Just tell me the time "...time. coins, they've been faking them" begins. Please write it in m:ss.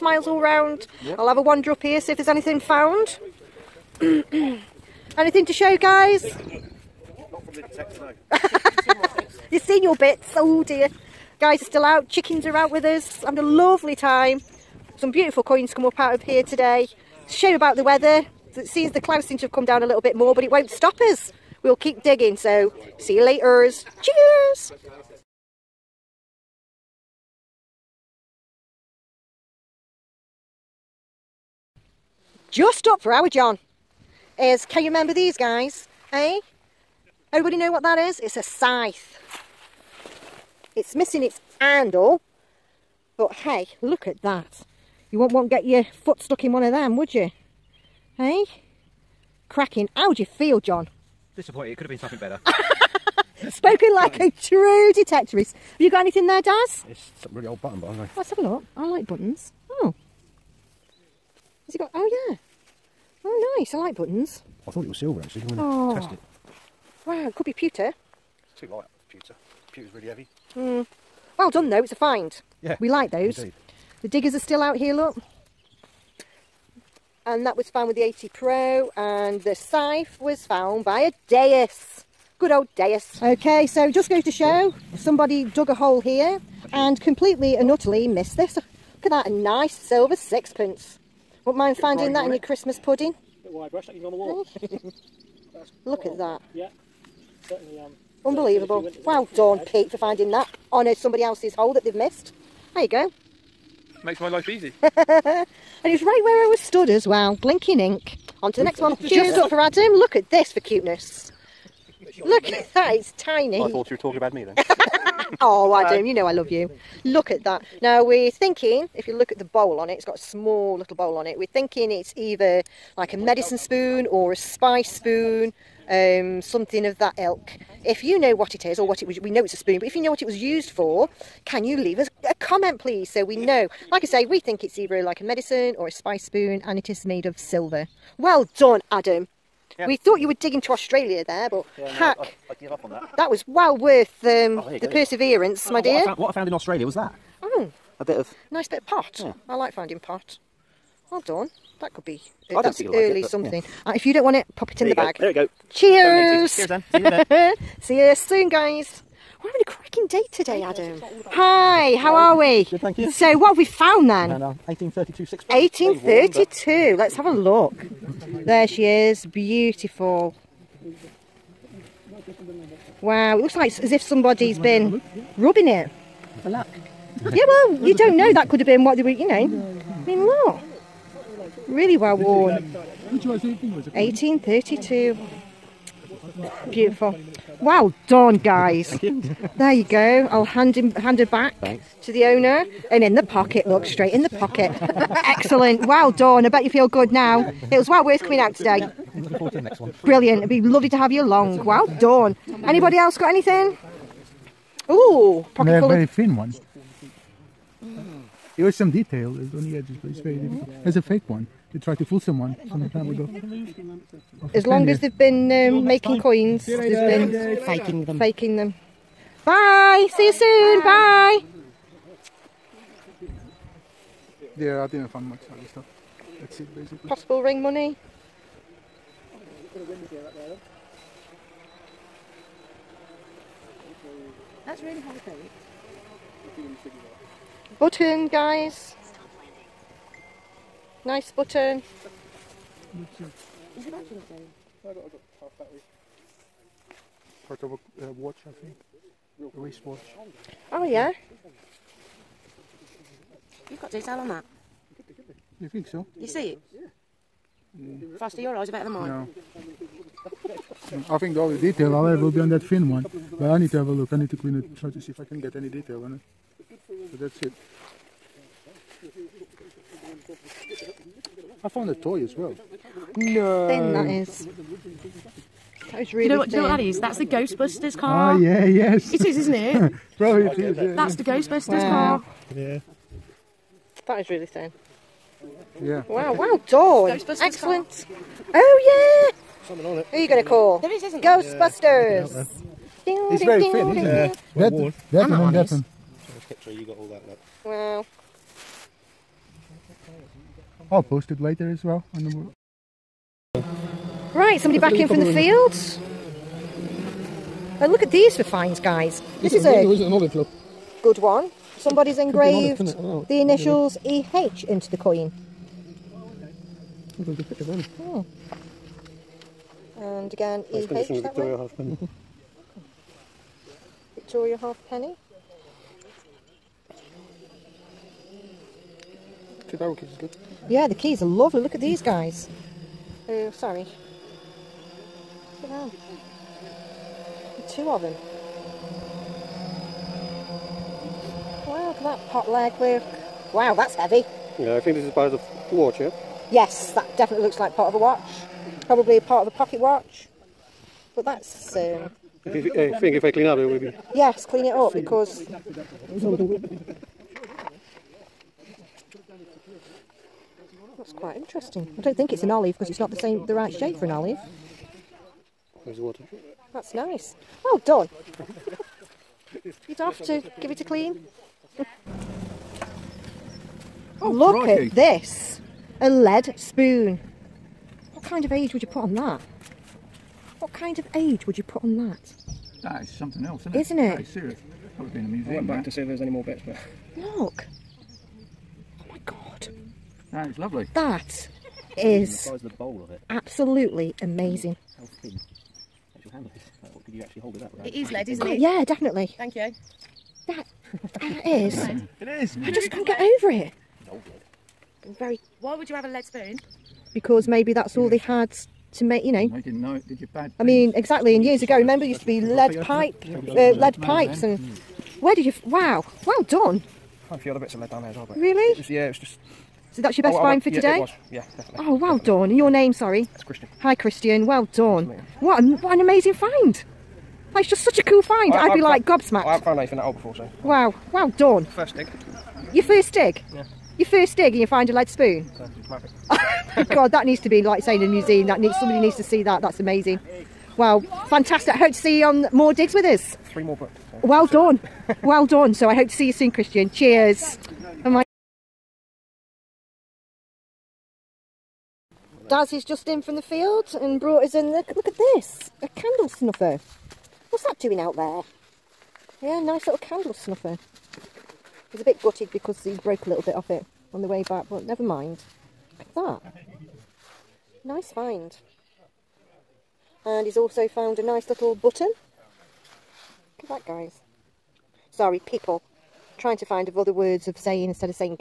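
3:36.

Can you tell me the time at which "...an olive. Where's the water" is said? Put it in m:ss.
6:04.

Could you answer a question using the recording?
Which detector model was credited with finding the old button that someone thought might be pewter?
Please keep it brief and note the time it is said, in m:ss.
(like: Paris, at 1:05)
AT Pro, at 1:18.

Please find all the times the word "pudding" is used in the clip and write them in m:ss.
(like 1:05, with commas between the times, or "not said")
1:32.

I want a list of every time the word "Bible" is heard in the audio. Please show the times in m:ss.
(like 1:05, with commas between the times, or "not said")
not said.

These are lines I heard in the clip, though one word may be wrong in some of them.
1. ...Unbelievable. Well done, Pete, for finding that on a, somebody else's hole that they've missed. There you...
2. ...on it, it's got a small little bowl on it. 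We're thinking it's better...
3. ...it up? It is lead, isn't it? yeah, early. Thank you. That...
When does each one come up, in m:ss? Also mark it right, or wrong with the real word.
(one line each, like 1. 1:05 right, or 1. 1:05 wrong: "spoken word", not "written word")
1. 1:38 right
2. 1:59 wrong: "either", not "better"
3. 6:37 wrong: "definitely", not "early".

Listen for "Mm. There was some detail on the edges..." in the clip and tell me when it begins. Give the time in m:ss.
3:27.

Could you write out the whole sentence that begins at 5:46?
Yes, that definitely looks like part of a watch.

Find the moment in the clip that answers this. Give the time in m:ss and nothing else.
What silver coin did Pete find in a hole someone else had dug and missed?
1:29.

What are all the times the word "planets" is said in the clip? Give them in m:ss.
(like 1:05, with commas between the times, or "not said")
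not said.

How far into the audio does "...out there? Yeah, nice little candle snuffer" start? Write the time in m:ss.
7:37.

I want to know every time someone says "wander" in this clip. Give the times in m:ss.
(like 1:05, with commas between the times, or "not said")
0:01.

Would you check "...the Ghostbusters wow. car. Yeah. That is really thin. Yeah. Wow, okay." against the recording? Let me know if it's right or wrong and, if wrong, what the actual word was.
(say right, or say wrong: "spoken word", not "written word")
right.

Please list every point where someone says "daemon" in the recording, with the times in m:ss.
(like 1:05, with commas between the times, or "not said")
not said.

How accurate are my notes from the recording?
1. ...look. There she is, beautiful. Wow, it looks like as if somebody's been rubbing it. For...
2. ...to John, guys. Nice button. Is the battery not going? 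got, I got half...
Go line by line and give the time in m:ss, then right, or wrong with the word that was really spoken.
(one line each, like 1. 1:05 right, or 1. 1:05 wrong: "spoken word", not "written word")
1. 2:47 right
2. 3:55 wrong: "Button", not "John".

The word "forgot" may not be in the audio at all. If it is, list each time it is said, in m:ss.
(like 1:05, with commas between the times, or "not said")
not said.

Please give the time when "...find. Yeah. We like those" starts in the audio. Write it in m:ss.
1:11.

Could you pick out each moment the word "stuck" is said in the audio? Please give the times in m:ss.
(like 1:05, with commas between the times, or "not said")
0:46.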